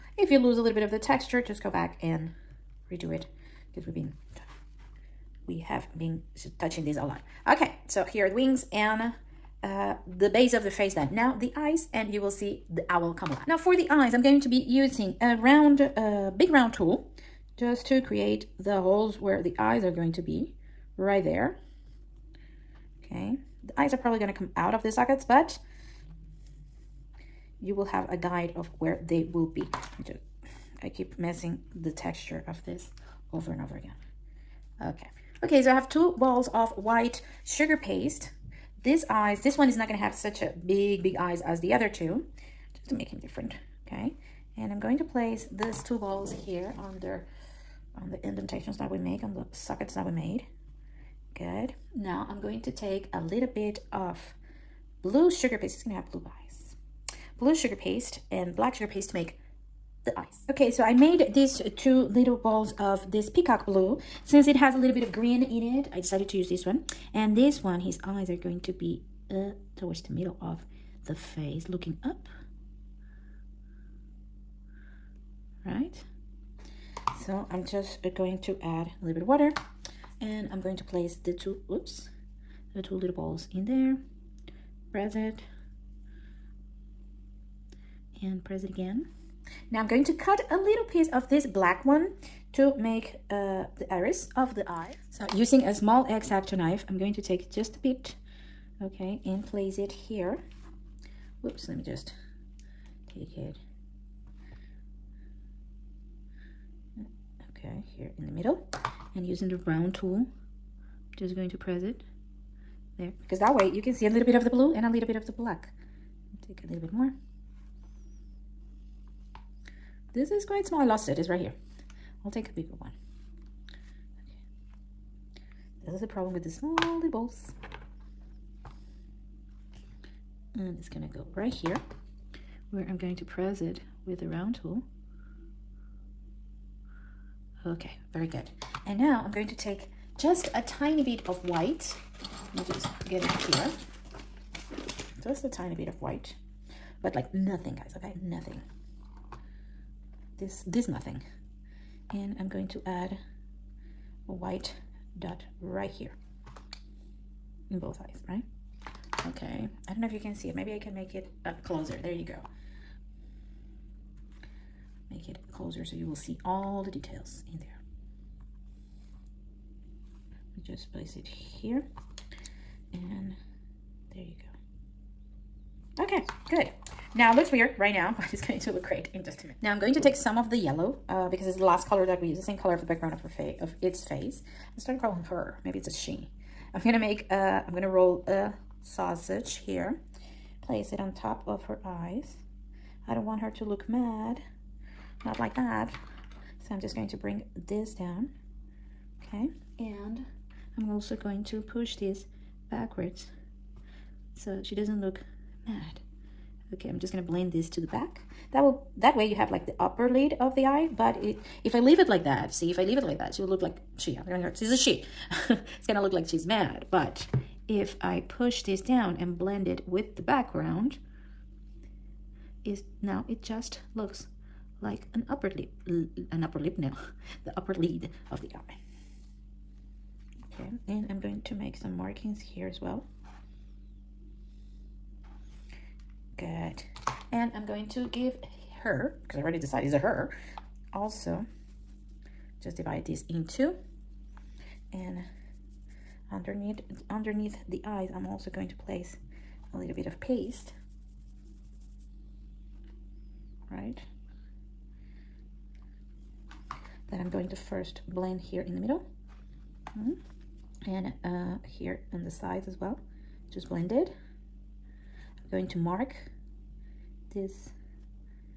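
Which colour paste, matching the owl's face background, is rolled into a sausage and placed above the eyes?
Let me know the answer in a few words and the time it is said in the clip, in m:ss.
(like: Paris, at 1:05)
yellow, at 3:00.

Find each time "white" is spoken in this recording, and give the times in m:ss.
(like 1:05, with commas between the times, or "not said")
0:36, 2:21, 2:26, 2:34.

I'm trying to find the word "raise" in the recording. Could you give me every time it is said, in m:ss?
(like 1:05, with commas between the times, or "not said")
not said.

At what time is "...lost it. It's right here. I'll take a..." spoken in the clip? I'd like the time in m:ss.
2:00.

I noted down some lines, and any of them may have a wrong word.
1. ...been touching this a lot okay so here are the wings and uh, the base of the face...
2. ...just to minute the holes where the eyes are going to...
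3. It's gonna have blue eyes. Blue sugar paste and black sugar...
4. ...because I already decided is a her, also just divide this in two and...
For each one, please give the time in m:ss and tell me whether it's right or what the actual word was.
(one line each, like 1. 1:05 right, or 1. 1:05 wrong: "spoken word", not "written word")
1. 0:05 right
2. 0:17 wrong: "create", not "minute"
3. 0:55 right
4. 3:59 right.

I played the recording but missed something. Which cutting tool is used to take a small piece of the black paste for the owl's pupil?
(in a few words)
exacto knife.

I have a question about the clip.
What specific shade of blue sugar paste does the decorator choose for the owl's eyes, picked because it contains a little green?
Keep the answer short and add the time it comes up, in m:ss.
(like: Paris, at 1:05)
peacock blue, at 1:03.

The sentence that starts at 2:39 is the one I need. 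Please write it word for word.
Okay, I don't know if you can see it.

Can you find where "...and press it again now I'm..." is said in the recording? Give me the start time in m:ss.
1:28.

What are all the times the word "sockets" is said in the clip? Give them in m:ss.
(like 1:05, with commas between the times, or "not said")
0:24, 0:49.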